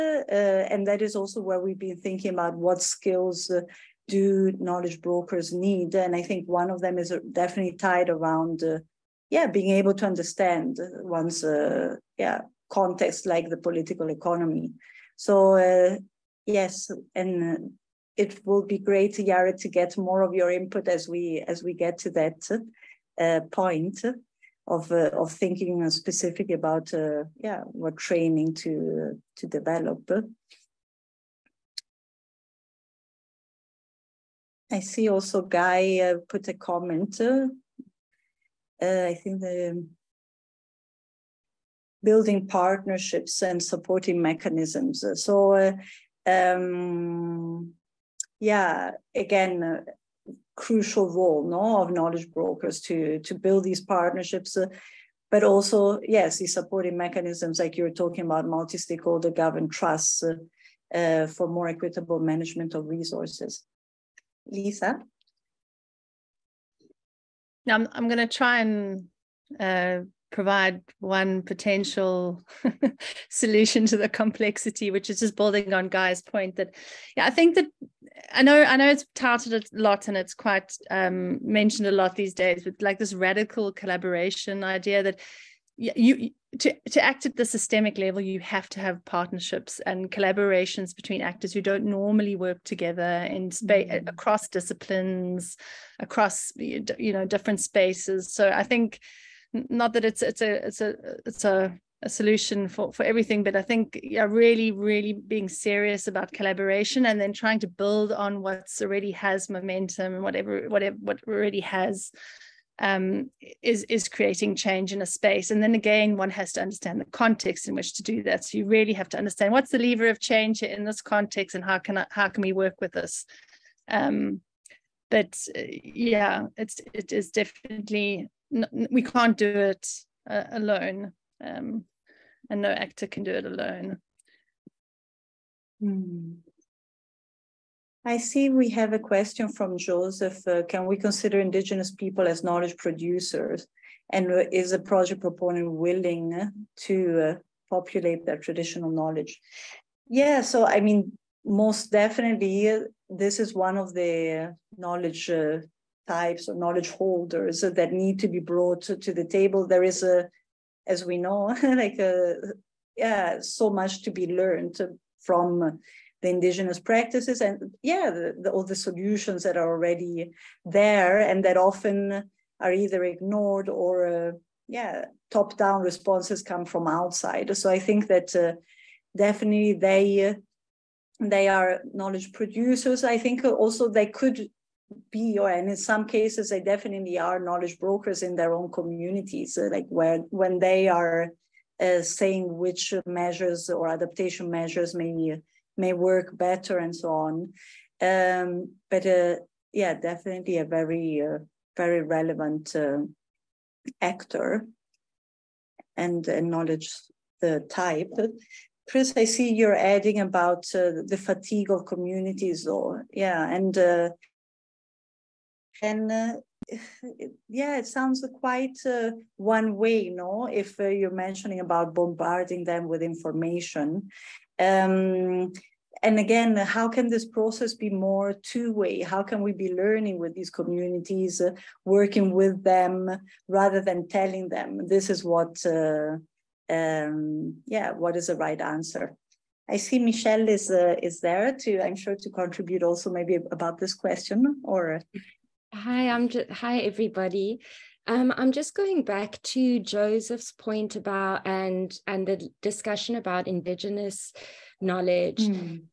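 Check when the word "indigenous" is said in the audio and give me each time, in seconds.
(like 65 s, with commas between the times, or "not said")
141 s, 166 s, 253 s.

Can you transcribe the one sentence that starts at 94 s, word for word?
across disciplines, across you know different spaces.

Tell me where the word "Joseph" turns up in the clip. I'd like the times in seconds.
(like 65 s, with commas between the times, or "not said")
139 s, 249 s.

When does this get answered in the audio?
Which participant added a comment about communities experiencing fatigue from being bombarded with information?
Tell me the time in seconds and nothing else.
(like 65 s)
208 s.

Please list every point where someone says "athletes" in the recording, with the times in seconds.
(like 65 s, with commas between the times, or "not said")
not said.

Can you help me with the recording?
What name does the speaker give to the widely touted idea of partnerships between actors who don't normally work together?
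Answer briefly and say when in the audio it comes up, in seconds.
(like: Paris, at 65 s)
Radical collaboration, at 83 s.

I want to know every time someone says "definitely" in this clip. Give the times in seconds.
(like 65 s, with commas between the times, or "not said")
7 s, 127 s, 151 s, 179 s, 186 s, 199 s.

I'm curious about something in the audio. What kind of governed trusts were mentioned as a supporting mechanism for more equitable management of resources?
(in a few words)
Multi-stakeholder.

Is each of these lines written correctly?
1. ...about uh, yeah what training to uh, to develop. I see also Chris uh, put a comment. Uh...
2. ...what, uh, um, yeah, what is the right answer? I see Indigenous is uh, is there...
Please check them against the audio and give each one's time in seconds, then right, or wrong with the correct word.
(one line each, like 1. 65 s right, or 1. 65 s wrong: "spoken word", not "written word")
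1. 26 s wrong: "Guy", not "Chris"
2. 235 s wrong: "Michelle", not "Indigenous".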